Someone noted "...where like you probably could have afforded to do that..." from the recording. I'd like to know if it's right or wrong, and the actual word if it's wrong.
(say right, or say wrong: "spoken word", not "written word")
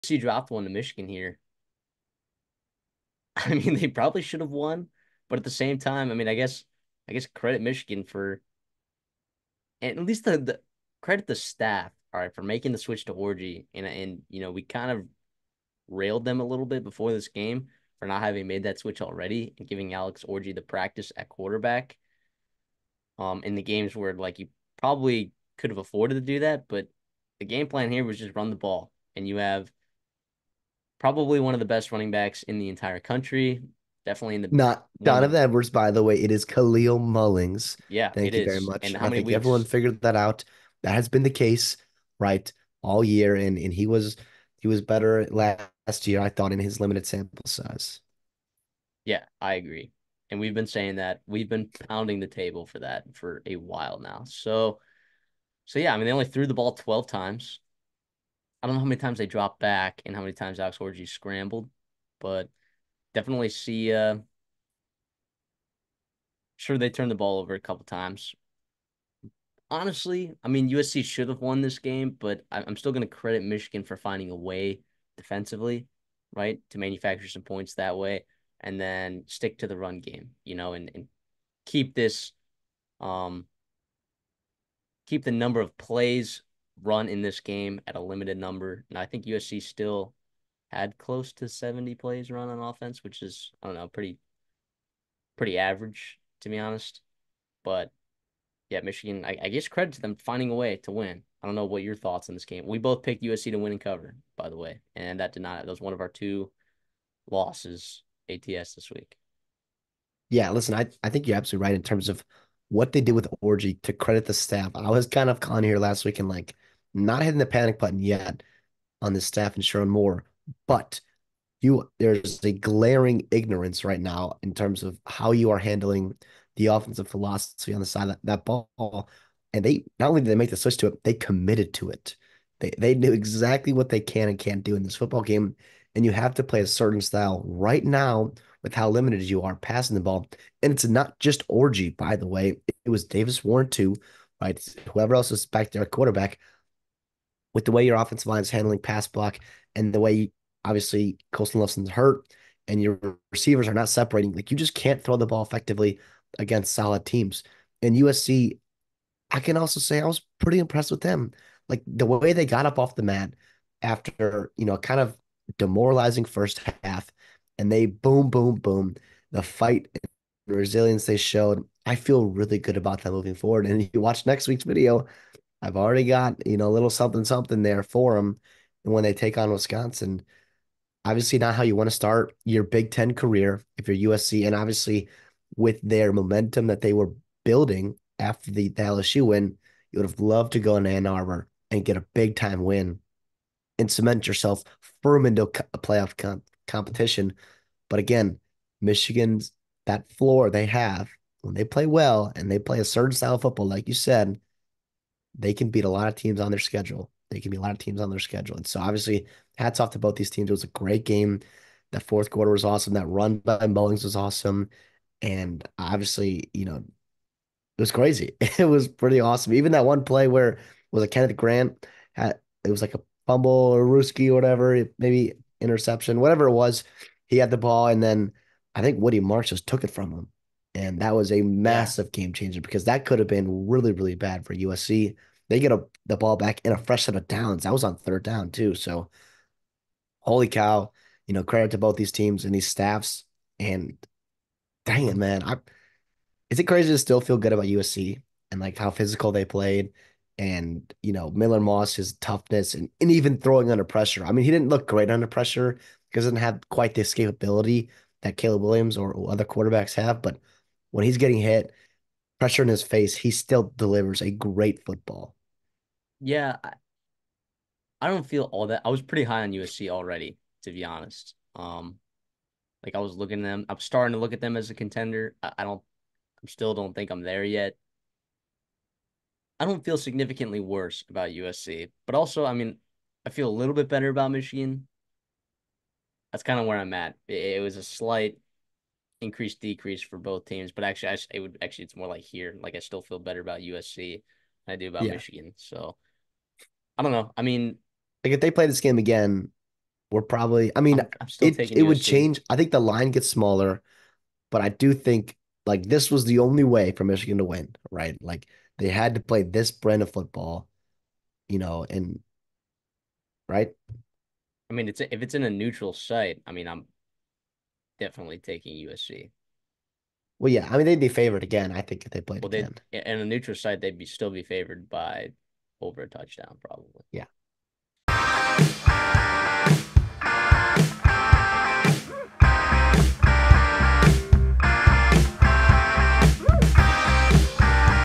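right.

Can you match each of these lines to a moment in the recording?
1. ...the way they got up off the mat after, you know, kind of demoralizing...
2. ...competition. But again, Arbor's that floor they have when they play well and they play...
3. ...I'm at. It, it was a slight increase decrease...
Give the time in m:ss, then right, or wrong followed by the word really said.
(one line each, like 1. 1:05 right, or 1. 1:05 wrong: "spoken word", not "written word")
1. 2:41 right
2. 3:16 wrong: "Michigan", not "Arbor"
3. 4:46 right.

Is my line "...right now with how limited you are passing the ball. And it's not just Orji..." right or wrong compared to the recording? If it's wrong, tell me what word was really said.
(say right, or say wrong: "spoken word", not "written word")
right.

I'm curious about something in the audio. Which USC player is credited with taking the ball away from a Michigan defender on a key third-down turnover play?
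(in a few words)
Woody Marks.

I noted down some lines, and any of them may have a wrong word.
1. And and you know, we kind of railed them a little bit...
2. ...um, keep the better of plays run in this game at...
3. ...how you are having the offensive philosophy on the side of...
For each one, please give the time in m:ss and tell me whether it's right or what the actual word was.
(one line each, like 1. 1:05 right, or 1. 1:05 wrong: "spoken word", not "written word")
1. 0:13 right
2. 1:22 wrong: "number", not "better"
3. 2:05 wrong: "handling", not "having".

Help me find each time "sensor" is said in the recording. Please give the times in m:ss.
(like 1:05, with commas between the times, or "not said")
not said.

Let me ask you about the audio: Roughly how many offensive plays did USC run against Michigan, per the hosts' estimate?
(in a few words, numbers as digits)
70.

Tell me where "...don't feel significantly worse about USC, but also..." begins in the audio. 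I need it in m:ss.
4:39.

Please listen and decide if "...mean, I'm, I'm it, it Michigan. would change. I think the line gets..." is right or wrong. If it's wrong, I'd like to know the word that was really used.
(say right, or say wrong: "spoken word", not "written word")
wrong: "USC", not "Michigan".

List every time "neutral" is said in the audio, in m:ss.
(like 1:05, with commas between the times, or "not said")
5:15, 5:23.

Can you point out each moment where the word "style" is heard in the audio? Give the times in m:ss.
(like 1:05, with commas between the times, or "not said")
2:17, 3:23.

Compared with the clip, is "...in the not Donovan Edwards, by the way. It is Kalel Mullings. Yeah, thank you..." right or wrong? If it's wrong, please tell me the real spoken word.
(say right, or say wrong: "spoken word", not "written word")
right.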